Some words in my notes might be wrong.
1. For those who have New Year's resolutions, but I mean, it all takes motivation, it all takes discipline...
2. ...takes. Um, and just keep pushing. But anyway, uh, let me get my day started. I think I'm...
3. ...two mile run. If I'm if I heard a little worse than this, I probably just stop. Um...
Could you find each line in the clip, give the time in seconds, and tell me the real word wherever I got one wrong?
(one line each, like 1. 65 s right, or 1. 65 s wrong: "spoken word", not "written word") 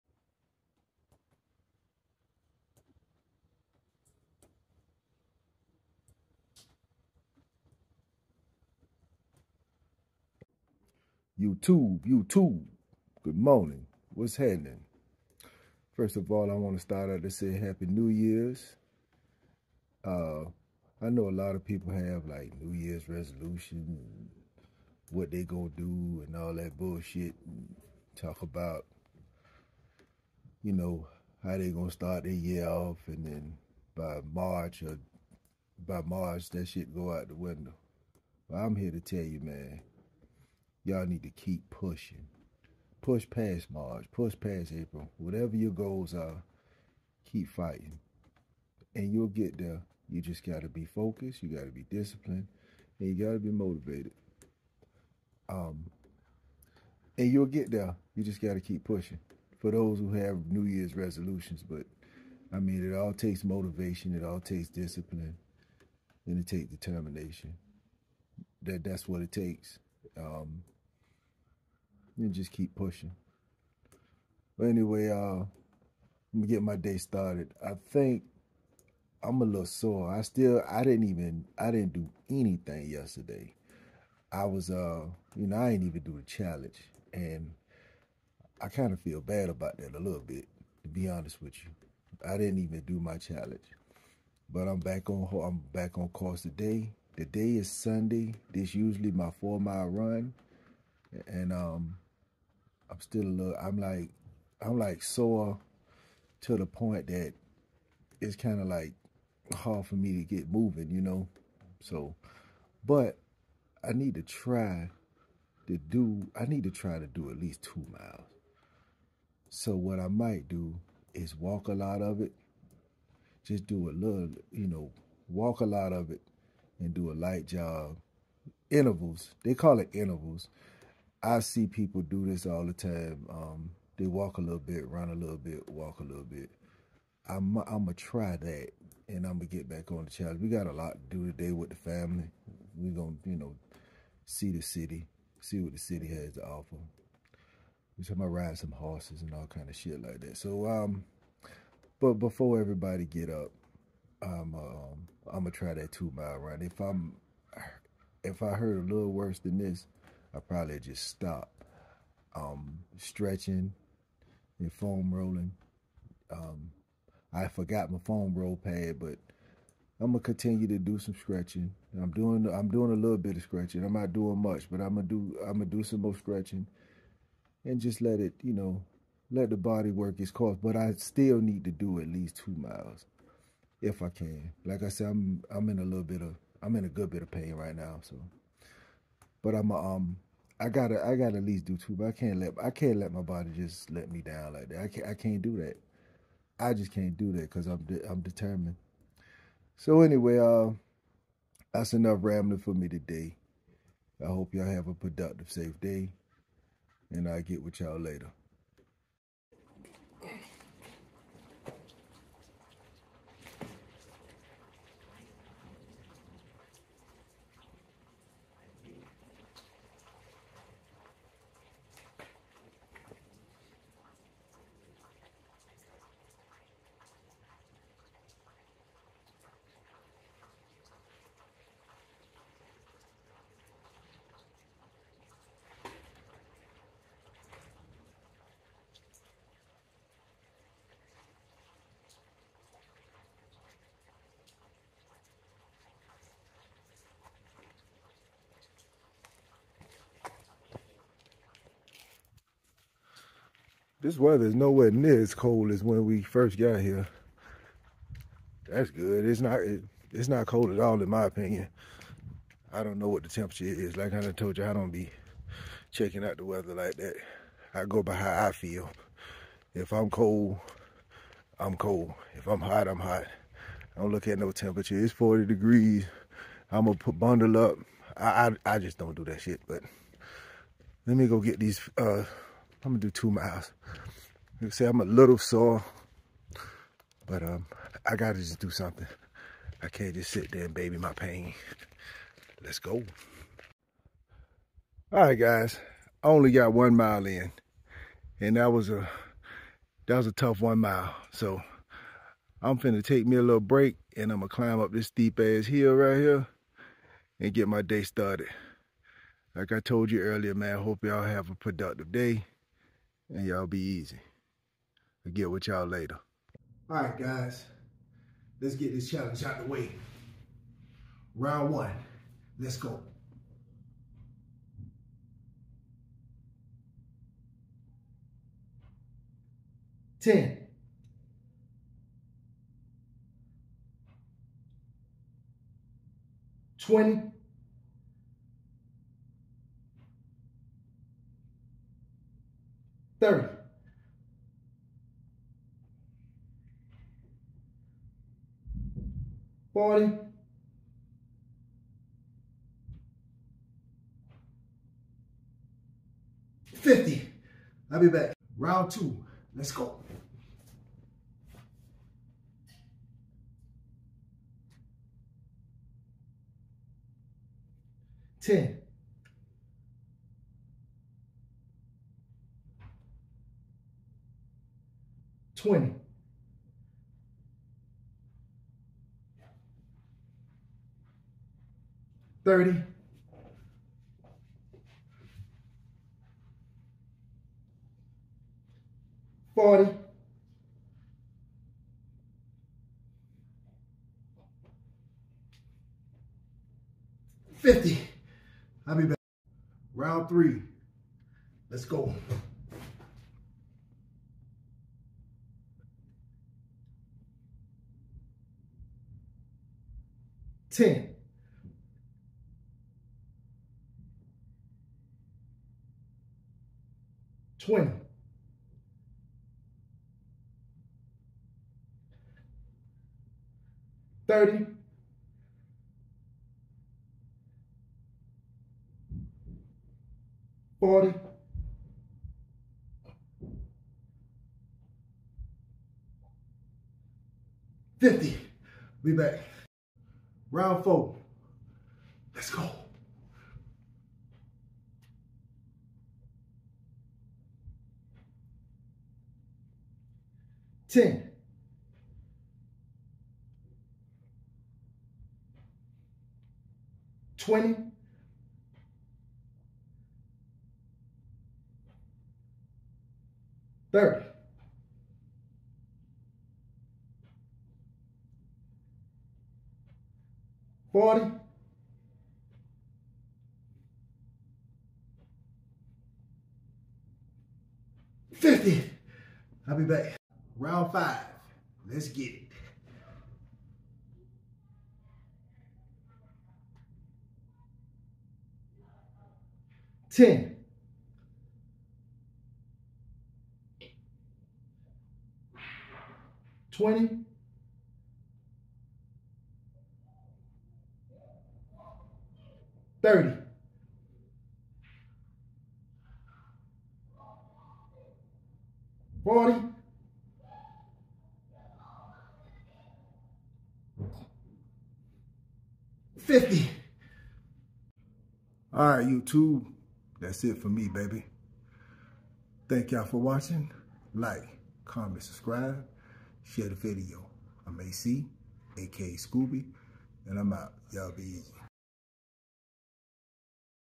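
1. 59 s right
2. 69 s right
3. 155 s right.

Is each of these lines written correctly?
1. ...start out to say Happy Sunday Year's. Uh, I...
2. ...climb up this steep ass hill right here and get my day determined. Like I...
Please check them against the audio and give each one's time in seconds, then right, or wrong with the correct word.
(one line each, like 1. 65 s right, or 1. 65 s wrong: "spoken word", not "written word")
1. 16 s wrong: "New", not "Sunday"
2. 304 s wrong: "started", not "determined".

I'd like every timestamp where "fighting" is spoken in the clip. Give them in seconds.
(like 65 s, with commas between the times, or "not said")
47 s.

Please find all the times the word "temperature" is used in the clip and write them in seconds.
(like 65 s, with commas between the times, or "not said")
263 s, 274 s.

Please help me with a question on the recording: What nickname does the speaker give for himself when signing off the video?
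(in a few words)
Scoobie.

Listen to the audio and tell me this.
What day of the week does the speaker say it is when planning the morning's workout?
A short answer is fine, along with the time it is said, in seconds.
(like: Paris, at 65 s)
Sunday, at 97 s.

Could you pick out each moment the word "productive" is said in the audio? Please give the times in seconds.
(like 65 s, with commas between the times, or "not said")
204 s, 311 s.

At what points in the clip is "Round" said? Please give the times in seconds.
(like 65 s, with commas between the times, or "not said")
321 s, 358 s, 399 s, 440 s, 480 s.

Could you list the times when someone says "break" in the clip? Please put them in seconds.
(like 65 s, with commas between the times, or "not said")
303 s.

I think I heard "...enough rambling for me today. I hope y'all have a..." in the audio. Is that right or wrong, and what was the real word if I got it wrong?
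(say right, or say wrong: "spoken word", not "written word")
right.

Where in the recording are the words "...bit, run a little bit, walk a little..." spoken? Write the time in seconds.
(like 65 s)
134 s.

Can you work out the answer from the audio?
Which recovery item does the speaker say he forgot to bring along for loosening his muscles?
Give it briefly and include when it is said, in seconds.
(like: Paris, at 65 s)
foam roll pad, at 168 s.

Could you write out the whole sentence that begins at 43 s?
Push past March, push past April.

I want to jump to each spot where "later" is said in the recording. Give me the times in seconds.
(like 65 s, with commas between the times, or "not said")
207 s, 315 s.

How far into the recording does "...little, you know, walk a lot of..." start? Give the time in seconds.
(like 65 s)
123 s.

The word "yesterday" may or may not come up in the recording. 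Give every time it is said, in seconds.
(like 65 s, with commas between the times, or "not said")
82 s.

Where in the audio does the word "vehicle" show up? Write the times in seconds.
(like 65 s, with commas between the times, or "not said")
not said.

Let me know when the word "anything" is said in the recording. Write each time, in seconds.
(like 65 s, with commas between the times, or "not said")
82 s.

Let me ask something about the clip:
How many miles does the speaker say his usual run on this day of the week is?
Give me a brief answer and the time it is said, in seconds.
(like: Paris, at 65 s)
4, at 99 s.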